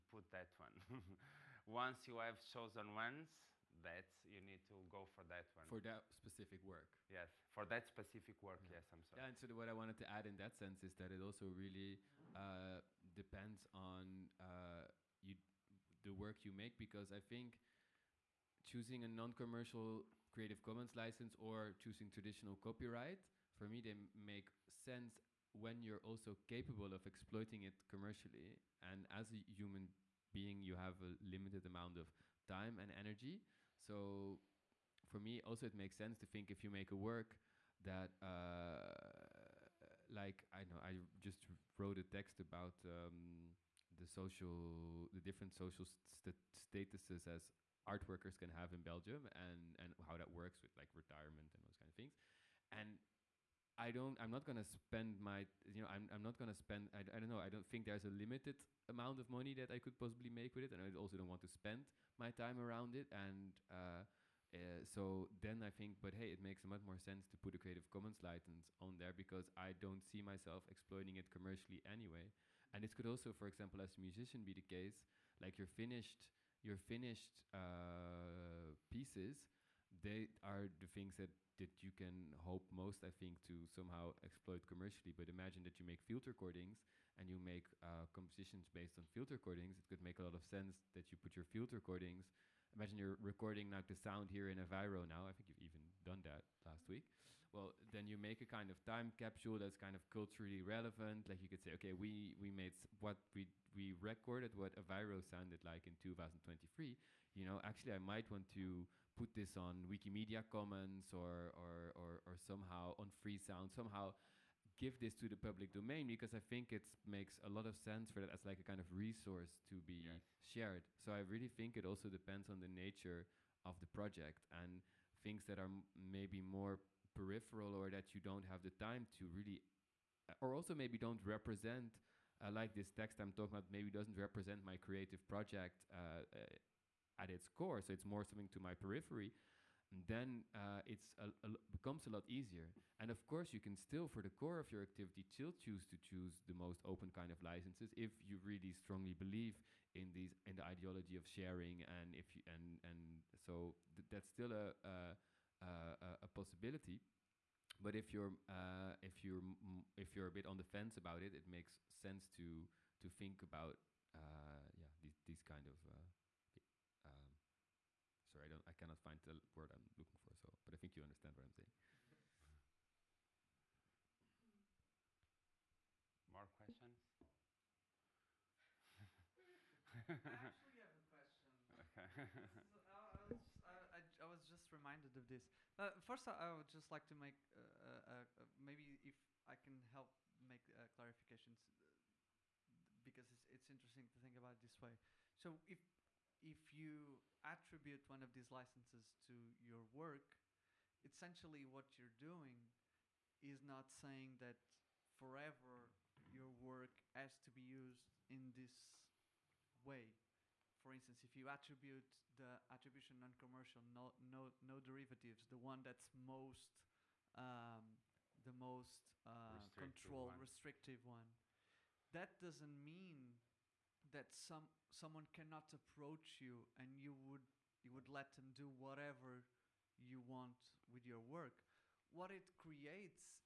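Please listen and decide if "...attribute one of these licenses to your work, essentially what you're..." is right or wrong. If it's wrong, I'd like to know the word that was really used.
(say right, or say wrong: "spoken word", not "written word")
right.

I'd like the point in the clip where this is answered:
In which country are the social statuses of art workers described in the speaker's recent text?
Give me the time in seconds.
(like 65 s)
48 s.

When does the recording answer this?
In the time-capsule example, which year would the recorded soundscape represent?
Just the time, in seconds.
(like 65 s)
105 s.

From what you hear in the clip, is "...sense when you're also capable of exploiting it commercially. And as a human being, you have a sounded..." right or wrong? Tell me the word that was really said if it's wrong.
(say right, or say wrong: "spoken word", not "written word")
wrong: "limited", not "sounded".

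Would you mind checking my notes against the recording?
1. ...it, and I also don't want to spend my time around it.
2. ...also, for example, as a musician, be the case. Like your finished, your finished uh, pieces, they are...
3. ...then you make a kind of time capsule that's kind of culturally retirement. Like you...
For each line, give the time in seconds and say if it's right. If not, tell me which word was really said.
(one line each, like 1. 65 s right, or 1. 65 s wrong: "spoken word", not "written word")
1. 60 s right
2. 73 s right
3. 97 s wrong: "relevant", not "retirement".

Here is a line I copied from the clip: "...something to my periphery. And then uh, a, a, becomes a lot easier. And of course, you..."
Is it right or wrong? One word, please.
right.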